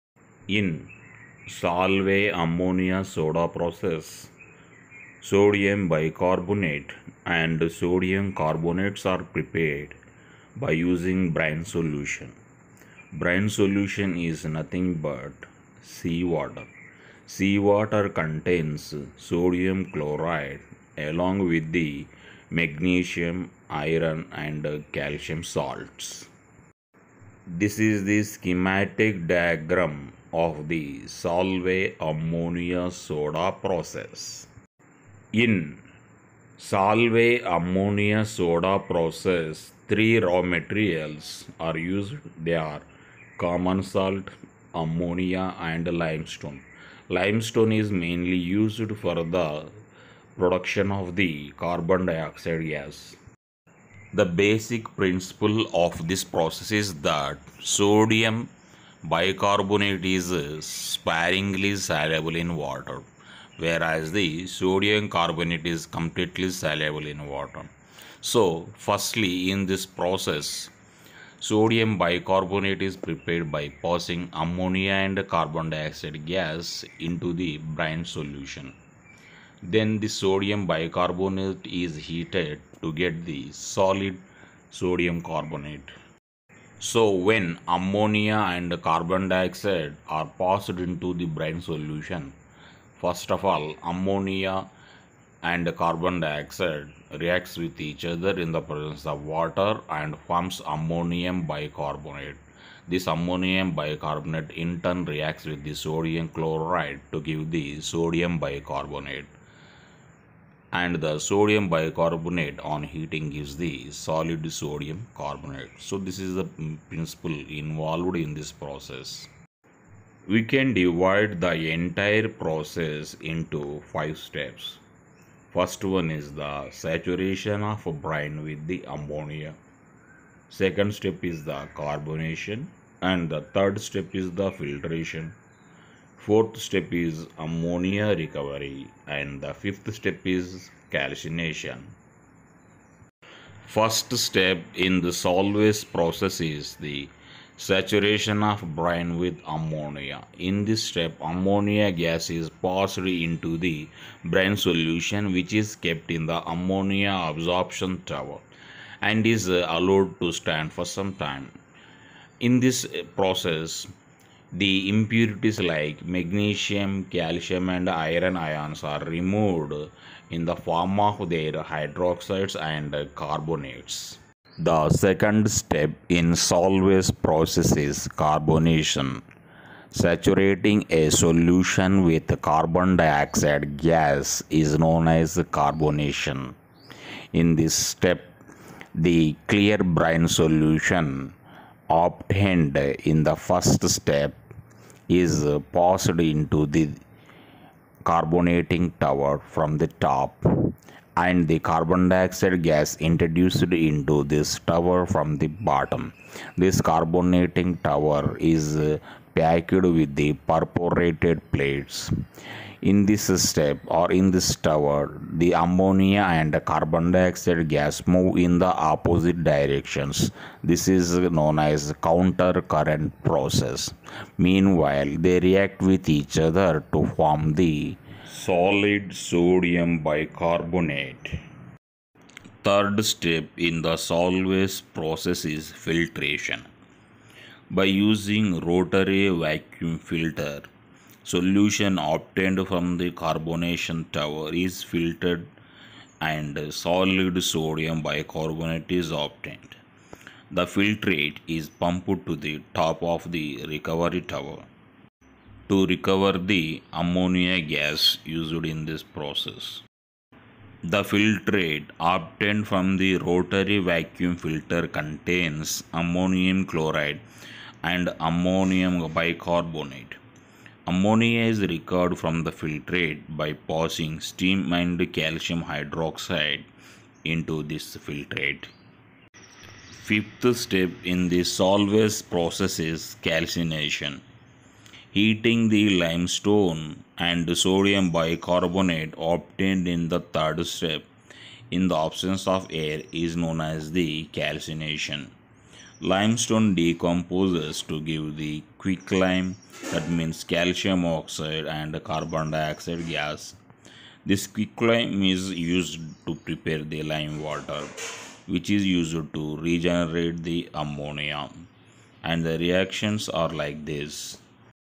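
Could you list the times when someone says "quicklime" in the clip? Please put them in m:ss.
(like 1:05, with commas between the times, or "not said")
4:58, 5:04.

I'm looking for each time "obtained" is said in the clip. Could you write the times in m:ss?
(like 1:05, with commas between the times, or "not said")
3:11, 4:01, 4:09, 4:21, 4:49.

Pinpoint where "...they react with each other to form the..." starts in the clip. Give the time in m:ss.
3:45.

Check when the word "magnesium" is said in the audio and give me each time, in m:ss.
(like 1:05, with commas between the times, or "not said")
0:22, 2:46.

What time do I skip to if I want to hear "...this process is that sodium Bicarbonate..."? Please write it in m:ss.
0:56.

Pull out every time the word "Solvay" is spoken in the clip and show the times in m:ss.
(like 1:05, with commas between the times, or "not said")
0:01, 0:31, 0:36, 2:25, 2:56, 3:54, 4:41.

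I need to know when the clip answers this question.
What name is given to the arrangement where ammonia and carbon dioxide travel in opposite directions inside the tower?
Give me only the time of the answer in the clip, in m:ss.
3:42.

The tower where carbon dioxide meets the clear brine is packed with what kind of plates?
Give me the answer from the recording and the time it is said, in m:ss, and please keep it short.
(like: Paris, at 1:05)
Perforated plates, at 3:30.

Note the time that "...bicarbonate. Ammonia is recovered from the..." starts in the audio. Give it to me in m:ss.
4:29.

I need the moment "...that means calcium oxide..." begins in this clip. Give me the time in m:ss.
4:59.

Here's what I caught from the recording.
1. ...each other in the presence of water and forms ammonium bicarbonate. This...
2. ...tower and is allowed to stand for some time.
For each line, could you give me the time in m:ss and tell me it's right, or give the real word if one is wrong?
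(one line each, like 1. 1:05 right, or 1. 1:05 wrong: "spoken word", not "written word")
1. 1:37 right
2. 2:38 right.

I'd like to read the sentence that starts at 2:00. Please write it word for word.
We can divide the entire process into five steps.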